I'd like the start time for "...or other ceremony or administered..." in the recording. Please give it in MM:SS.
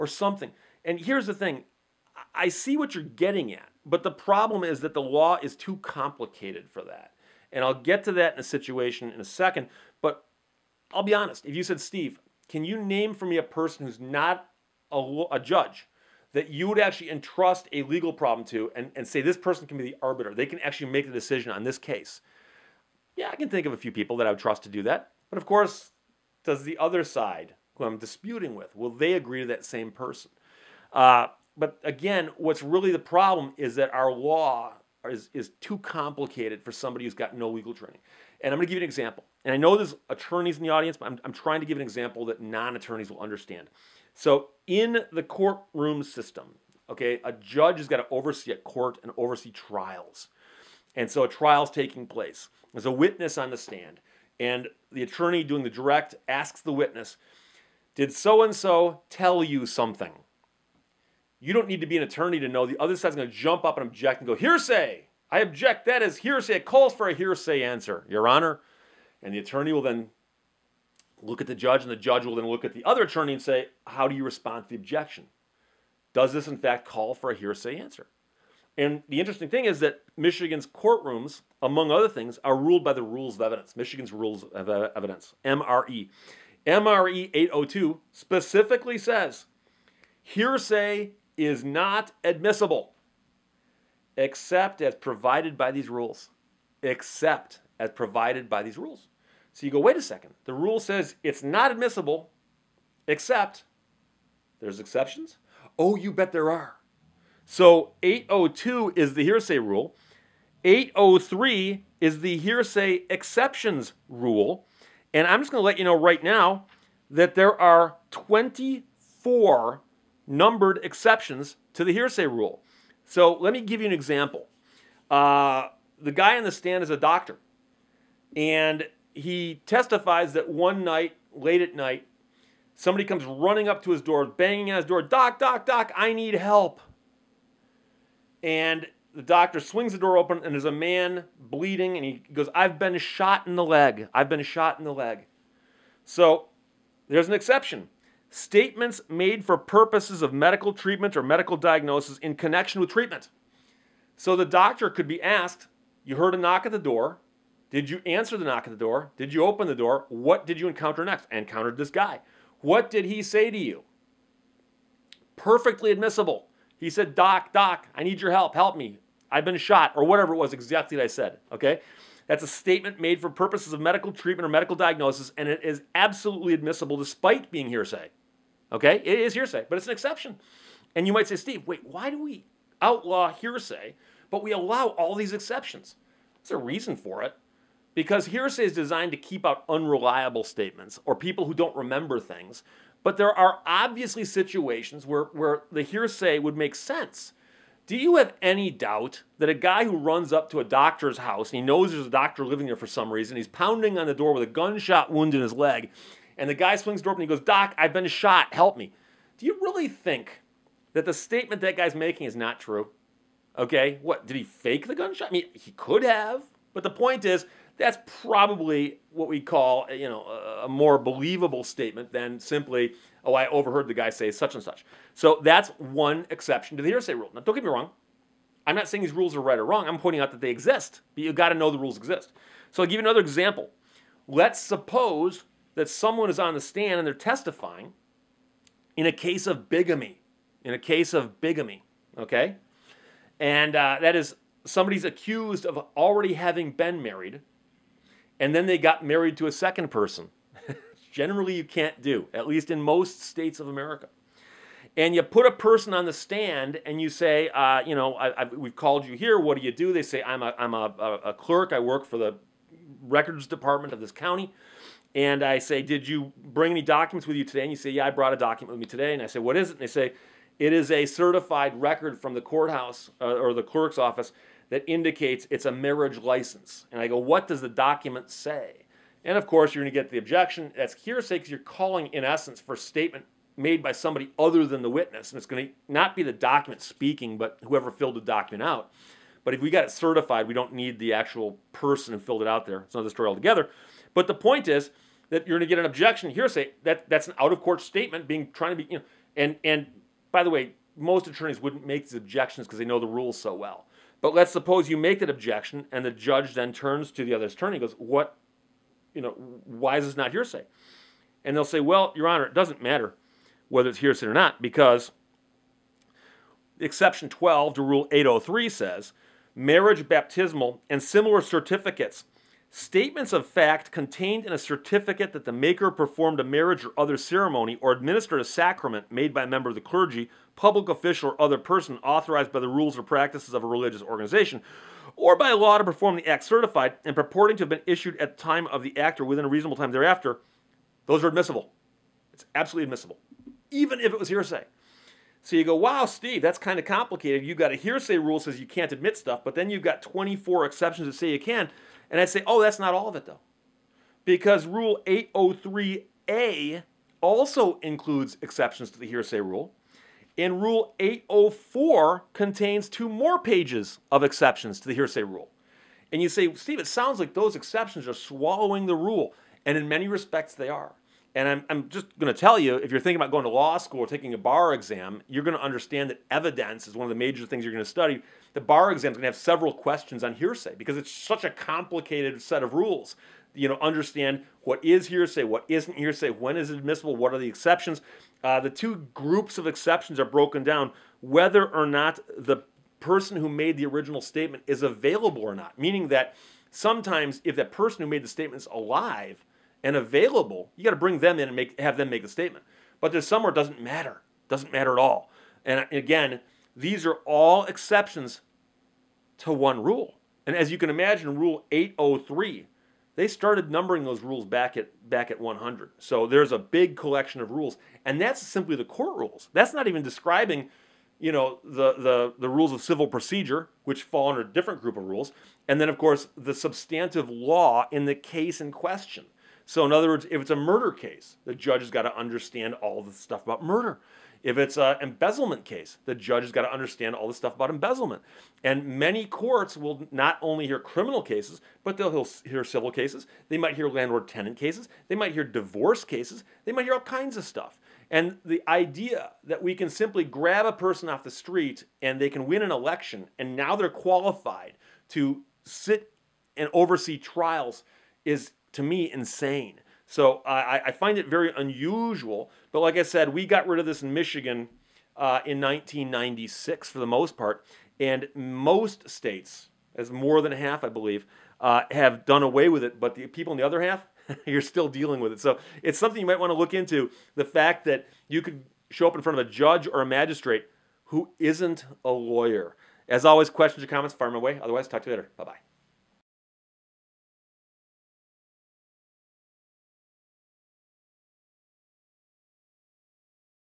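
05:26.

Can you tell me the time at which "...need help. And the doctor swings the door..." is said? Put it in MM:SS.
02:16.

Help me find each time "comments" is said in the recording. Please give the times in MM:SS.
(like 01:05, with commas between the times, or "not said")
08:03.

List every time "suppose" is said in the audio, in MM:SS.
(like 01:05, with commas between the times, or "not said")
03:54, 05:04.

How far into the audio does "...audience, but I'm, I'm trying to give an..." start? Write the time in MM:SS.
00:40.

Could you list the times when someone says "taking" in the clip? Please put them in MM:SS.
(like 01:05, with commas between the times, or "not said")
00:51, 06:14.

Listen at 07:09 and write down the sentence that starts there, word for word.
So, in other words, if it's a murder case, the judge has got to understand all the stuff about murder.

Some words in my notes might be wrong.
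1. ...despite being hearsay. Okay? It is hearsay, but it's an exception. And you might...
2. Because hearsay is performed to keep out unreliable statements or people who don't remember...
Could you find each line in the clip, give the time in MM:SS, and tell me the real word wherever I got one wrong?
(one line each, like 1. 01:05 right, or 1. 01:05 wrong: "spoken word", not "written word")
1. 02:56 right
2. 03:07 wrong: "designed", not "performed".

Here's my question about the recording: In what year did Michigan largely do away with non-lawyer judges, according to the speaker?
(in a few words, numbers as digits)
1996.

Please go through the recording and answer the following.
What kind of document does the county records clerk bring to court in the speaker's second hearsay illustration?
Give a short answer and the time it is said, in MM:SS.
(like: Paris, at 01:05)
Marriage license, at 04:35.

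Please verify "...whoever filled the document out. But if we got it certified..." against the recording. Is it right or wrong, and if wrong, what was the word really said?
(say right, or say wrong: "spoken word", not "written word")
right.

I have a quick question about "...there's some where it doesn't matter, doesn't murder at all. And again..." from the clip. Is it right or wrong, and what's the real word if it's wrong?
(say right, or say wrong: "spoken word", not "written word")
wrong: "matter", not "murder".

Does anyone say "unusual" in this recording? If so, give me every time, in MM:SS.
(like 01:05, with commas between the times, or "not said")
07:41.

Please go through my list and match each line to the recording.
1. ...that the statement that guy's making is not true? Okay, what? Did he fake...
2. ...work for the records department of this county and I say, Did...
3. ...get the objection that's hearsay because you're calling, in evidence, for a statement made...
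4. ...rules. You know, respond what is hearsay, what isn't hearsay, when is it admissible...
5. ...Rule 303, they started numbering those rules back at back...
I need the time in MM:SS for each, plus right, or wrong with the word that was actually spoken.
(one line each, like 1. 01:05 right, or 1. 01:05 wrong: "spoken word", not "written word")
1. 03:30 right
2. 04:21 right
3. 04:40 wrong: "essence", not "evidence"
4. 06:22 wrong: "understand", not "respond"
5. 06:51 wrong: "803", not "303".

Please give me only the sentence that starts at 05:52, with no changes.
And I'd say, oh, that's not all of it, though.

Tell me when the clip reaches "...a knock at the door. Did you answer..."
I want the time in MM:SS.
02:36.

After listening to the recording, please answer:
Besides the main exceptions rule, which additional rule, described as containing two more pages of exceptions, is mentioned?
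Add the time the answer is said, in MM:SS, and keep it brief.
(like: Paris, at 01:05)
Rule 804, at 06:00.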